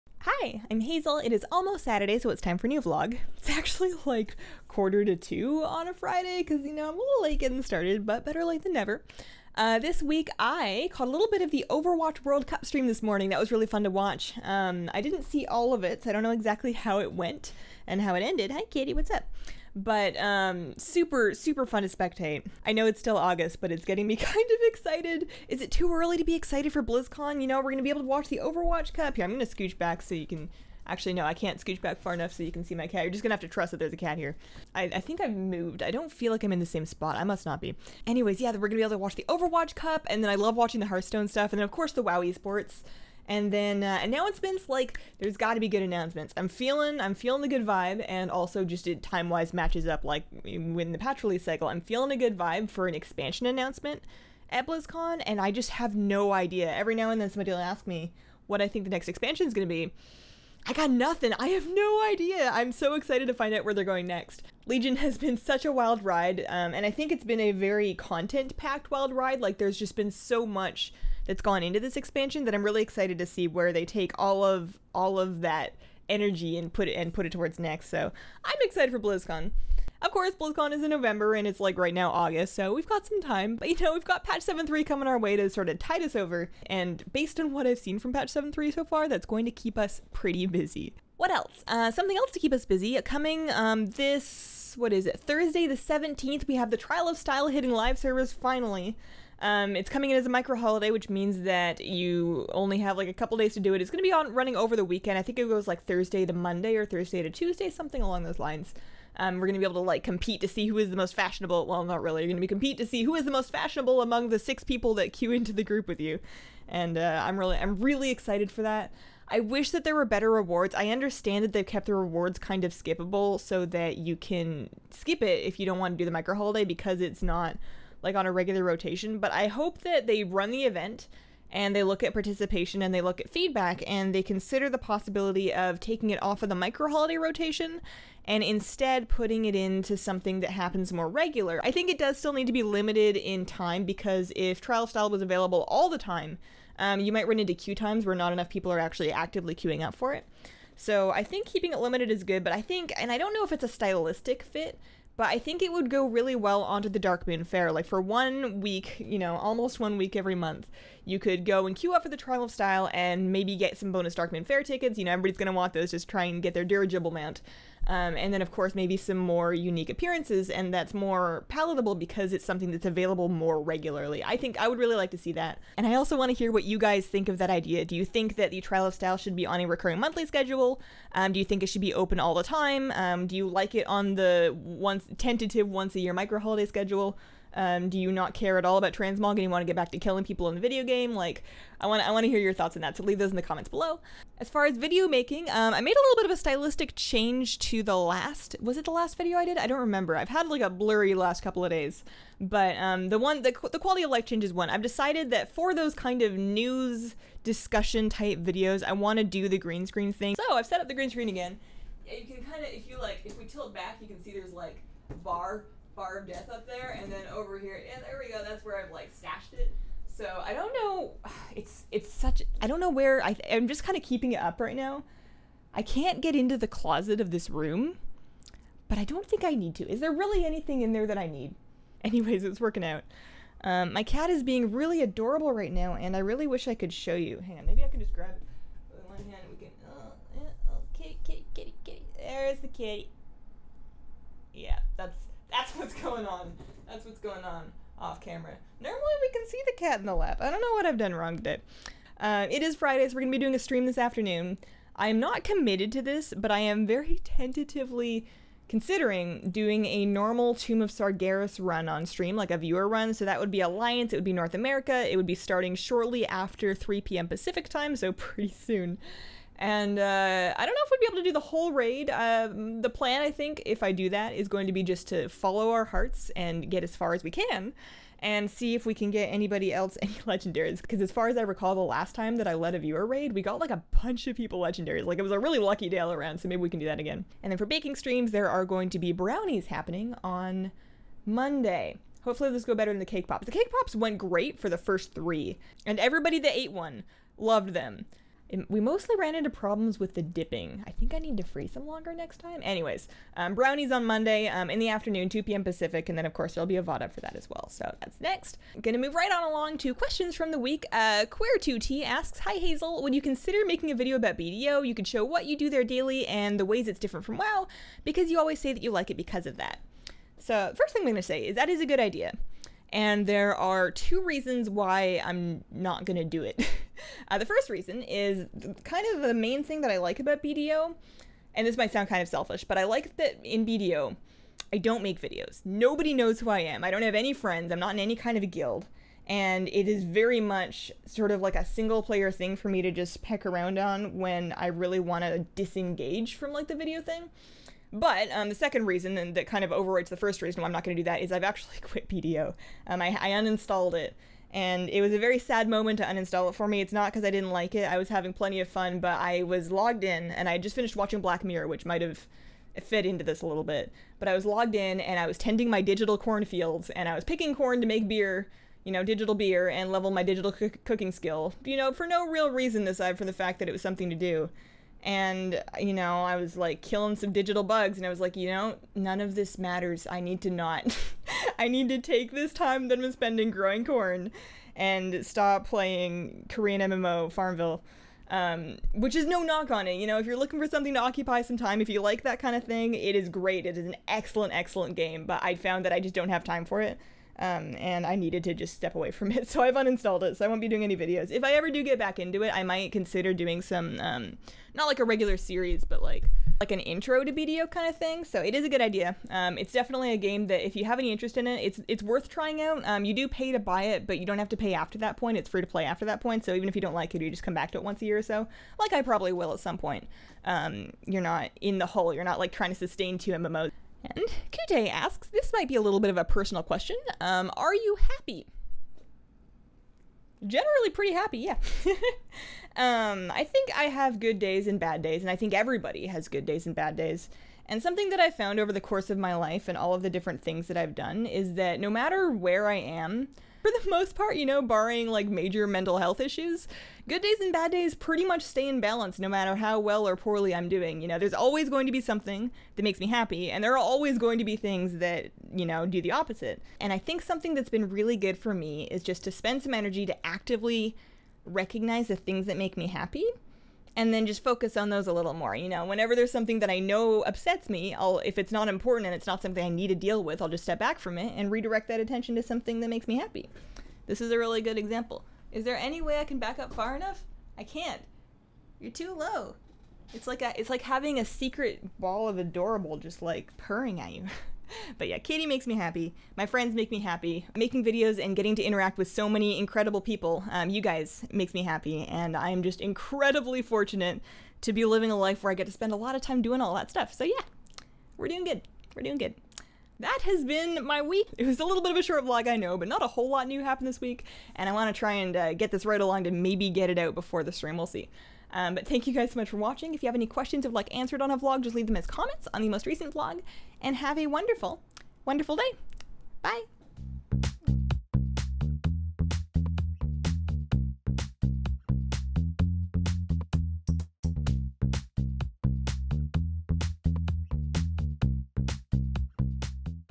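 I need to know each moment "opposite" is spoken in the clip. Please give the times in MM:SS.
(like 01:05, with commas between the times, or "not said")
07:36.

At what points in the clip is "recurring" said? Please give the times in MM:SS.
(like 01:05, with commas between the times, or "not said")
02:59.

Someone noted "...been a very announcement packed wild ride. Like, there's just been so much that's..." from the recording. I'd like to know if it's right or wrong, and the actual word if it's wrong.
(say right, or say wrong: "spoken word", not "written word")
wrong: "content", not "announcement".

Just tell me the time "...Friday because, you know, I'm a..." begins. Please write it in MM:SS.
00:05.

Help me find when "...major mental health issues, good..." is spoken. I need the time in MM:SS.
07:25.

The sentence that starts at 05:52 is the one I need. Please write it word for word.
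Um, I, I, uninstalled it and it was a very sad moment to uninstall it for me.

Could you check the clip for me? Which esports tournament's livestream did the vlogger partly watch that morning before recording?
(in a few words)
Overwatch World Cup.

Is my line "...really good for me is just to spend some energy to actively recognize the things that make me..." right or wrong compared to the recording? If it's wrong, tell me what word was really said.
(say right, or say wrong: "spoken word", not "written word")
right.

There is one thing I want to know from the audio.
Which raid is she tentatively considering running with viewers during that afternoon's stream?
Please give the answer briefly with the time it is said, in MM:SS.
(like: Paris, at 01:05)
Tomb of Sargeras, at 04:20.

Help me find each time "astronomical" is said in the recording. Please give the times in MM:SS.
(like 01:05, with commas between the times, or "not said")
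not said.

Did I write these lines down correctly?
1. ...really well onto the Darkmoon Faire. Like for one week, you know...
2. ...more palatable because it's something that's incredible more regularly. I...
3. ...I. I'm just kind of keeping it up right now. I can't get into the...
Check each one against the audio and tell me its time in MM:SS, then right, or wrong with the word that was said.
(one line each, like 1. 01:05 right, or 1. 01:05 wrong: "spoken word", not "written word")
1. 02:36 right
2. 02:50 wrong: "available", not "incredible"
3. 03:43 right.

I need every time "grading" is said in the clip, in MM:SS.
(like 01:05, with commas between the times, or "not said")
not said.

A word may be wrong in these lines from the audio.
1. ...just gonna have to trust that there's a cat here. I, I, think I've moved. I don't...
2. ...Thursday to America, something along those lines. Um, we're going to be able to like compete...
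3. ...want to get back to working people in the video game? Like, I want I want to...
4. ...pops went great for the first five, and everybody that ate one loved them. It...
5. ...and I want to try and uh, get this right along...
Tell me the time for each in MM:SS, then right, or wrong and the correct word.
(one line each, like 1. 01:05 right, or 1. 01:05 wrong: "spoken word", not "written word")
1. 00:33 right
2. 01:46 wrong: "Tuesday", not "America"
3. 03:09 wrong: "killing", not "working"
4. 04:53 wrong: "three", not "five"
5. 08:24 right.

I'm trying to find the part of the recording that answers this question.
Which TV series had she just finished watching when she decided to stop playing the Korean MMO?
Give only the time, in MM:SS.
06:01.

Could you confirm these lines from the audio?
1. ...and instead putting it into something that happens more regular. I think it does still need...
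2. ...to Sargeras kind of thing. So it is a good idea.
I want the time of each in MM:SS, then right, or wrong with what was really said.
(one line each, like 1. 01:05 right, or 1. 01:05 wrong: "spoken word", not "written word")
1. 02:18 right
2. 06:47 wrong: "BDO", not "Sargeras".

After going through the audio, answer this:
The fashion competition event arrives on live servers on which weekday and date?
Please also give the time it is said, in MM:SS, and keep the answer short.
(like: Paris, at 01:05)
Thursday the 17th, at 01:35.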